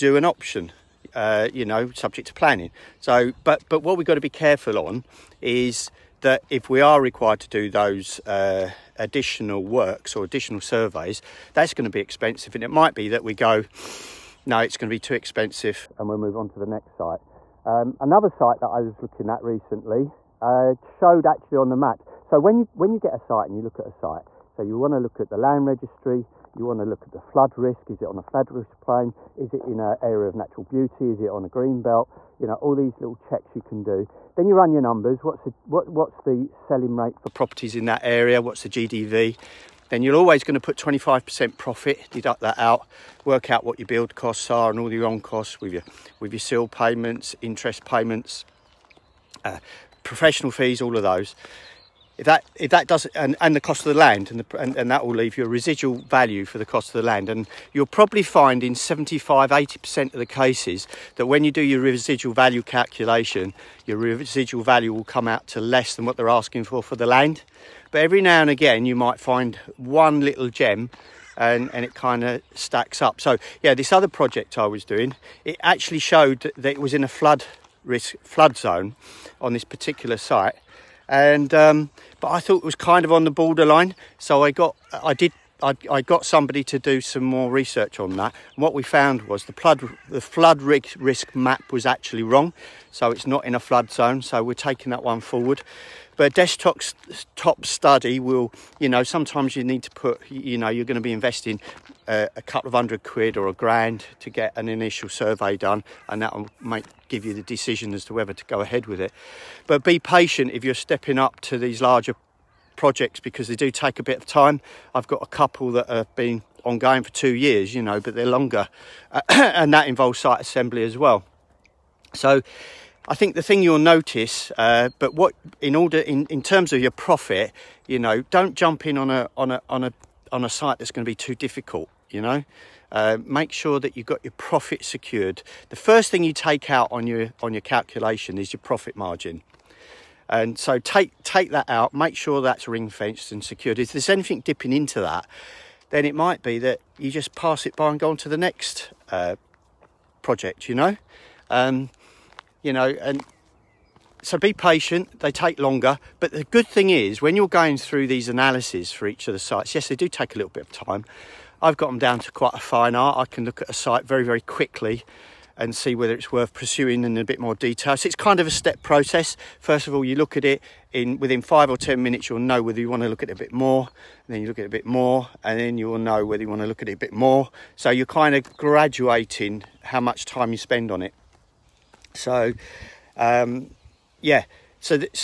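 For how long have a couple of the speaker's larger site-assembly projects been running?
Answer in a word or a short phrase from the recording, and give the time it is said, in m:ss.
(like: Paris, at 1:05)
2 years, at 1:57.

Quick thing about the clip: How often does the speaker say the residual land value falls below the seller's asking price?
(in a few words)
75-80%.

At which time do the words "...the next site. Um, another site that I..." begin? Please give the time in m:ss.
0:16.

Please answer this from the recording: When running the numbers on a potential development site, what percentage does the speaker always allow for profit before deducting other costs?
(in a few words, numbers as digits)
25%.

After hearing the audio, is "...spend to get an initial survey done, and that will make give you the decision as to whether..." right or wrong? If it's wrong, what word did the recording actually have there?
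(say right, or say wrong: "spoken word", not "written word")
wrong: "grand", not "spend".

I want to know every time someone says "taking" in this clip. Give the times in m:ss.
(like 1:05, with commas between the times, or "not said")
1:34.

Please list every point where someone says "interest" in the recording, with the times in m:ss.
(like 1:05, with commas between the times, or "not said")
0:47.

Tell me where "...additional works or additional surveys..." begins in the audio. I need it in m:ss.
0:08.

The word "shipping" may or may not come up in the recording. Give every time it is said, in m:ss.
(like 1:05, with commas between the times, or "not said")
not said.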